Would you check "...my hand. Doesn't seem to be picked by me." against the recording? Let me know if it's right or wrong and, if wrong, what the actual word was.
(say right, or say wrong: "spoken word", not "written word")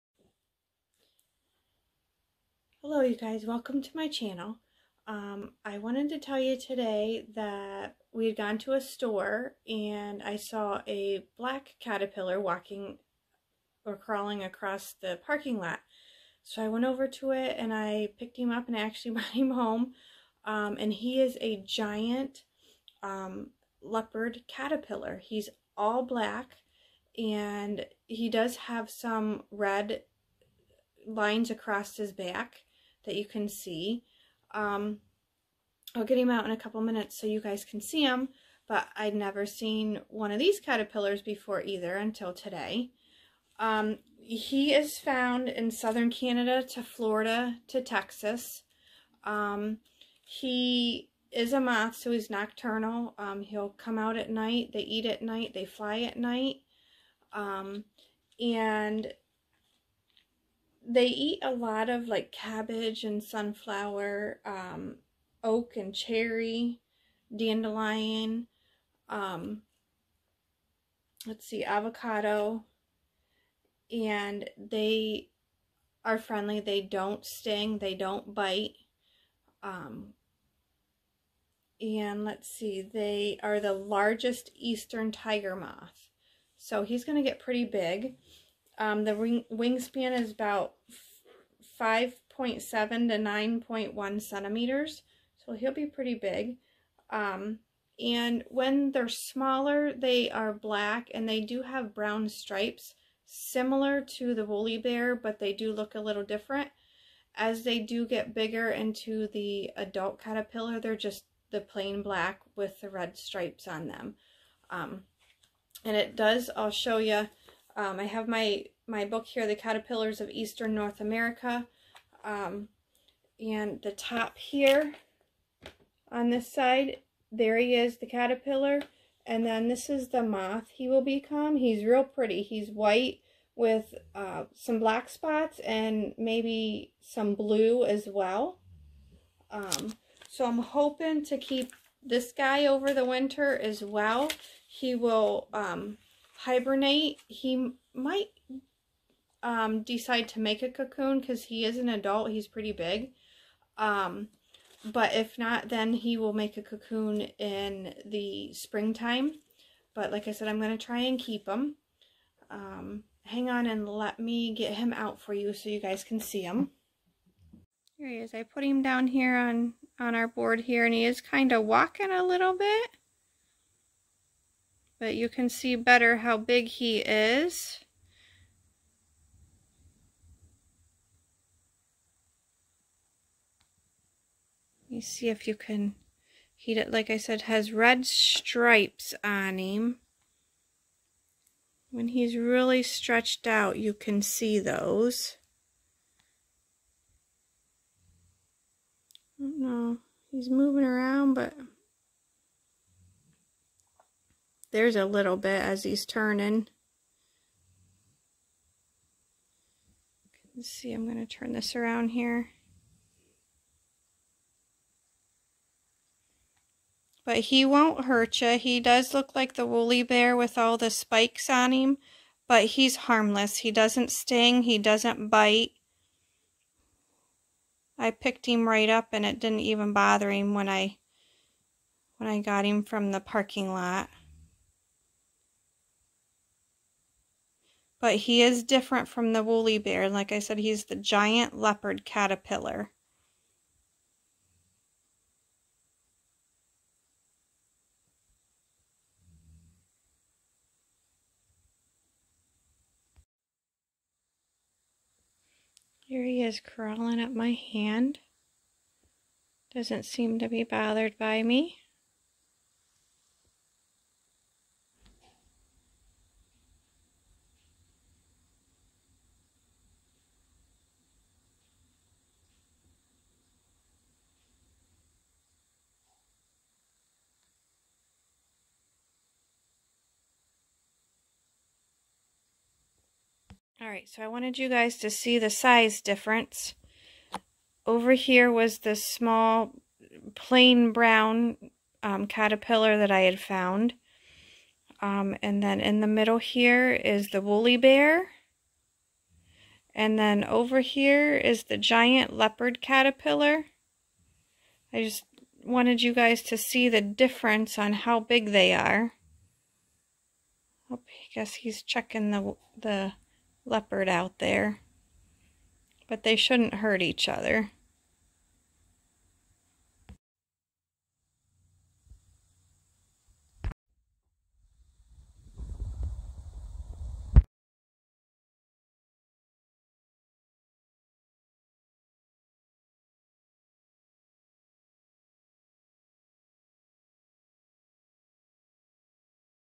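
wrong: "bothered", not "picked".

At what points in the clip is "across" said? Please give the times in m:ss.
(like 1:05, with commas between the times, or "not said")
0:14, 0:31.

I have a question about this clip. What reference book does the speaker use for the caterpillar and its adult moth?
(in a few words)
The Caterpillars of Eastern North America.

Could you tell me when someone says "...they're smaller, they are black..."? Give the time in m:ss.
1:38.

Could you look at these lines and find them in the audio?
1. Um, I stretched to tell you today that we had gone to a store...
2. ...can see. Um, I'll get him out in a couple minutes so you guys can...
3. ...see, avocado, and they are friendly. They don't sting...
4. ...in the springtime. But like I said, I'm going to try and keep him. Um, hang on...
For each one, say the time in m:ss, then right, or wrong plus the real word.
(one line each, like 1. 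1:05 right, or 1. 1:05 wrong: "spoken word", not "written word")
1. 0:05 wrong: "wanted", not "stretched"
2. 0:33 right
3. 1:11 right
4. 2:37 right.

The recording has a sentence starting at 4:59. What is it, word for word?
And then over here is the giant leopard caterpillar.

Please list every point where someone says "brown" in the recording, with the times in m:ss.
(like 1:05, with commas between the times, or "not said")
1:41, 4:50.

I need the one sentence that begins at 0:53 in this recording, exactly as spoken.
Um, he'll come out at night.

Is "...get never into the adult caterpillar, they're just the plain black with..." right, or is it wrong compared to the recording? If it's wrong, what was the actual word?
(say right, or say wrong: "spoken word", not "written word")
wrong: "bigger", not "never".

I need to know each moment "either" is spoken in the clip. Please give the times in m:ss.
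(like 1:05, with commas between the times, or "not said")
0:41.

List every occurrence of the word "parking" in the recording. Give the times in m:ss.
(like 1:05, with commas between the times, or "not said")
0:15, 3:53.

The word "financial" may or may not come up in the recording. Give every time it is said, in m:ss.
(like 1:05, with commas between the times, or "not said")
not said.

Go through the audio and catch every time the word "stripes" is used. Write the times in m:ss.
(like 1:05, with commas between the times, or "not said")
1:42, 1:53, 3:08.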